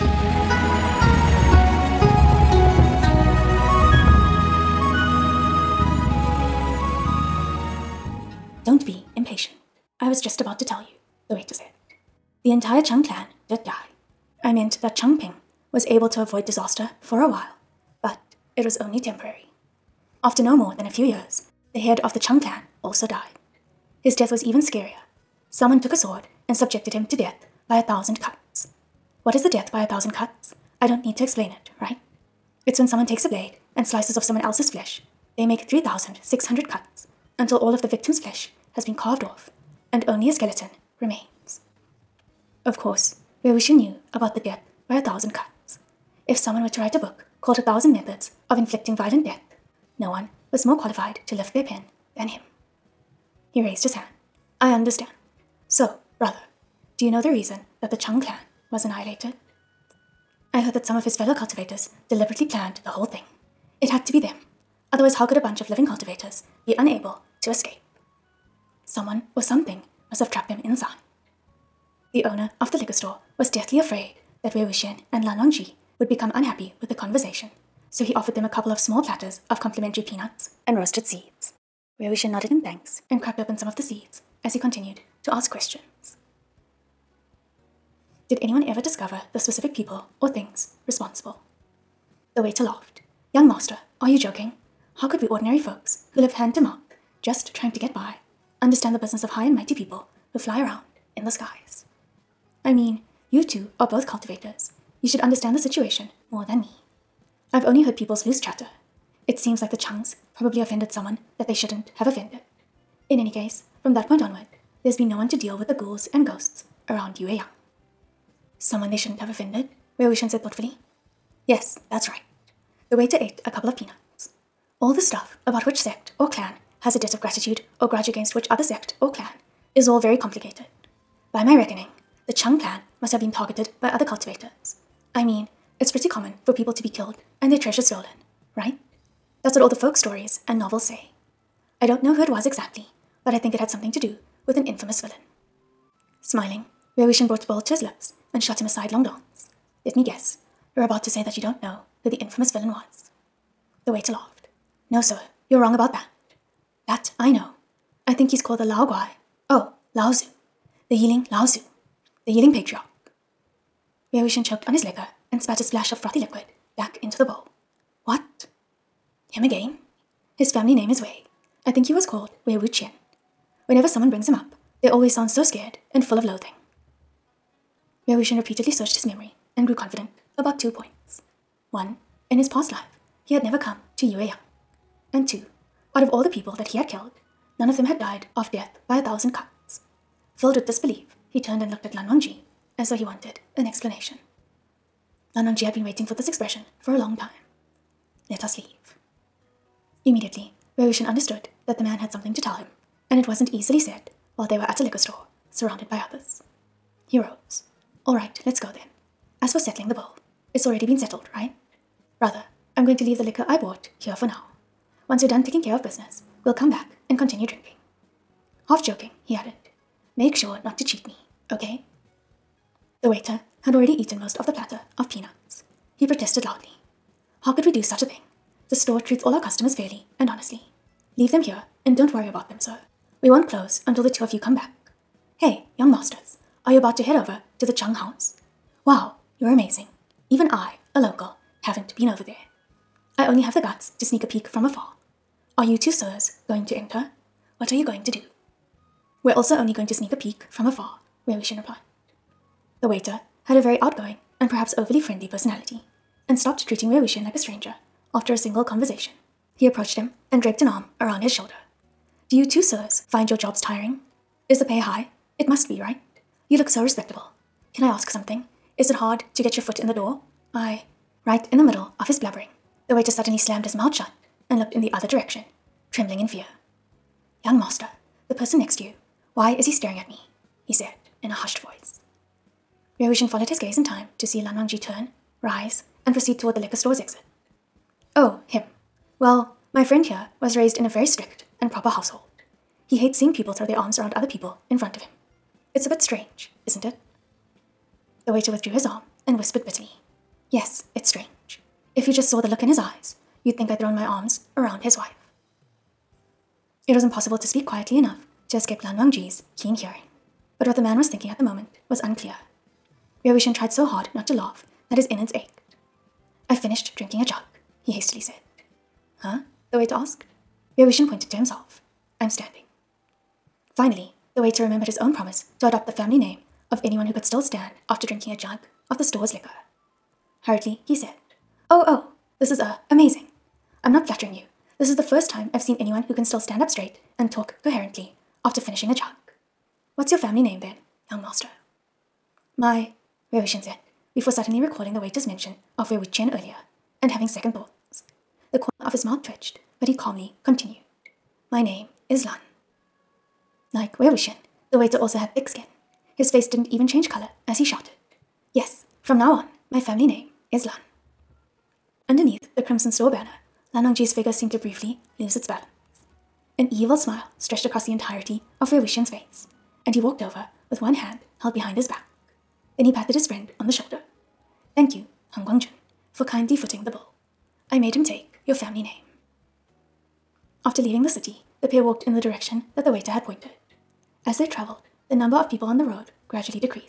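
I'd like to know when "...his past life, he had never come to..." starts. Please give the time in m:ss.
3:02.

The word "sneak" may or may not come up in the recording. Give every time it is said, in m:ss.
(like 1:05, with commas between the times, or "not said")
4:04, 4:09.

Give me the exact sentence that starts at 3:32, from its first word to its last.
Brother, I'm going to leave the liquor I bought here for now.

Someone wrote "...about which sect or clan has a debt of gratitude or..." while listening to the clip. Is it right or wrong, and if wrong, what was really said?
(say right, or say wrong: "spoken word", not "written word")
right.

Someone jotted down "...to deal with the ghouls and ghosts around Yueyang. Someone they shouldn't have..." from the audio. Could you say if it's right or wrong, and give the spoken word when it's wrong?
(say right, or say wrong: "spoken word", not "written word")
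right.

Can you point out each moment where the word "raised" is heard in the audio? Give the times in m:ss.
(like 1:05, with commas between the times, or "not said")
0:53, 4:50.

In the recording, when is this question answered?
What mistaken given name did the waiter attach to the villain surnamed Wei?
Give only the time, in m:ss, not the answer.
2:52.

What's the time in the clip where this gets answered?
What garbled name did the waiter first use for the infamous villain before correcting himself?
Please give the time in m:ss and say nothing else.
2:38.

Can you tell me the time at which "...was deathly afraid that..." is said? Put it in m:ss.
1:13.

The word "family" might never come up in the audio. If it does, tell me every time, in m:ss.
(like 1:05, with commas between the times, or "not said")
2:50, 5:25, 5:40, 5:59, 6:18.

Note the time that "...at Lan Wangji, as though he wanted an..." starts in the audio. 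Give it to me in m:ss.
3:11.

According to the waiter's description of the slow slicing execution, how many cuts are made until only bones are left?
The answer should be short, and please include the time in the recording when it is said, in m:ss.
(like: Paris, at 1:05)
3,600, at 0:35.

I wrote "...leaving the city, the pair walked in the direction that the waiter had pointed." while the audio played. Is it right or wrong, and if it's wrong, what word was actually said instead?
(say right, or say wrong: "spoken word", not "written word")
right.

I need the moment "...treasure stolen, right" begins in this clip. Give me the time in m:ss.
2:17.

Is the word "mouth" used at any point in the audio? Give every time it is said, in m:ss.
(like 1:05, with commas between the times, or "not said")
1:36, 4:33, 5:49.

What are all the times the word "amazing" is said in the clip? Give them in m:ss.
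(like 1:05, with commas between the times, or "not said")
3:59, 5:32.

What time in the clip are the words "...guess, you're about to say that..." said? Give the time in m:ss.
2:30.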